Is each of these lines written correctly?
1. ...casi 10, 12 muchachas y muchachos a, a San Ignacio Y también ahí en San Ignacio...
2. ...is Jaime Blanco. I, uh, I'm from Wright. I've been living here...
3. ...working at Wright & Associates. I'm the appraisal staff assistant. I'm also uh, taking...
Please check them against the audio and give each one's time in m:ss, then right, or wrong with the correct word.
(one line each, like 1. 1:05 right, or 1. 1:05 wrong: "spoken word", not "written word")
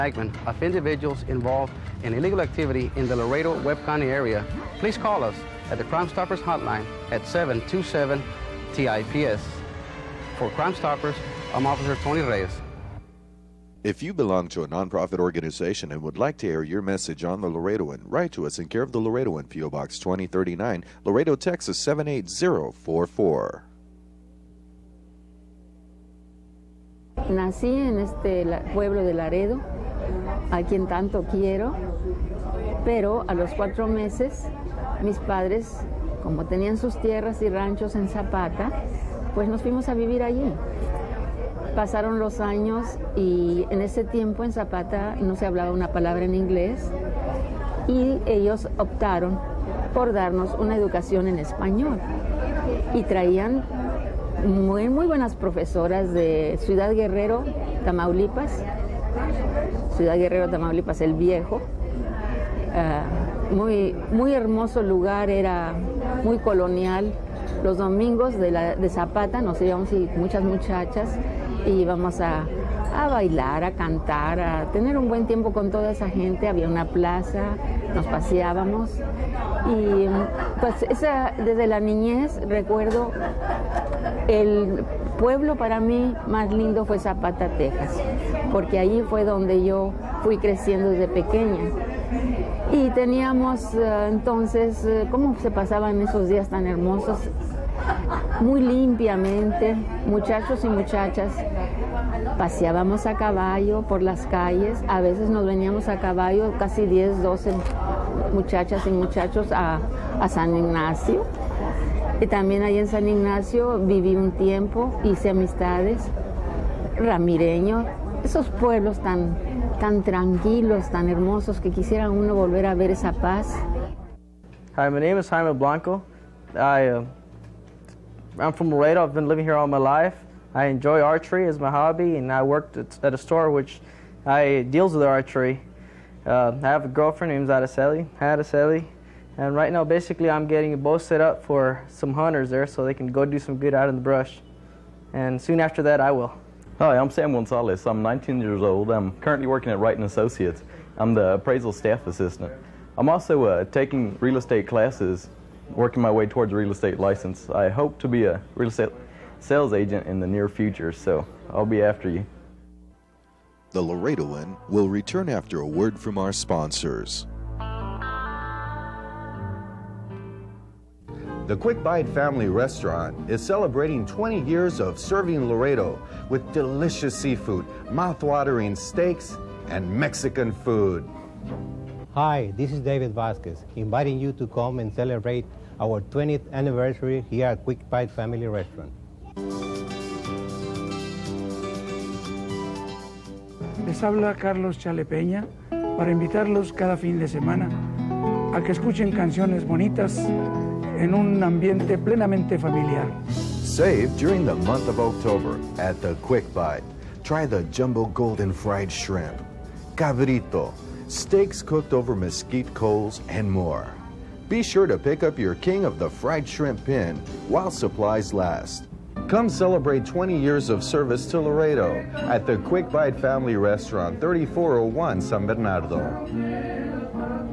1. 1:46 right
2. 2:05 wrong: "Laredo", not "Wright"
3. 2:29 right.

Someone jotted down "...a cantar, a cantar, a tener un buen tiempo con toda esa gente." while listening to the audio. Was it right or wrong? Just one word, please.
wrong.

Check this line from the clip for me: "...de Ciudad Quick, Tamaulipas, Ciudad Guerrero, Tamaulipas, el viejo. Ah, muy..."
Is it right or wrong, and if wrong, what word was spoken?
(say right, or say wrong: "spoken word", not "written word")
wrong: "Guerrero", not "Quick".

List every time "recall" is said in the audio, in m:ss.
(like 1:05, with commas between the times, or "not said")
not said.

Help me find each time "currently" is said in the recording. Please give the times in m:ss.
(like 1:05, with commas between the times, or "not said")
2:29.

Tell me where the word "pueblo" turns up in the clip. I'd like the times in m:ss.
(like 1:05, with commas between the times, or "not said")
0:28, 1:25, 1:58.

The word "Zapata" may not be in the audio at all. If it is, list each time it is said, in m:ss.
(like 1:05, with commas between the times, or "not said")
0:38, 0:44, 1:08, 1:26.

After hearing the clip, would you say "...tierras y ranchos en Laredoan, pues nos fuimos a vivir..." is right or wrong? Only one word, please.
wrong.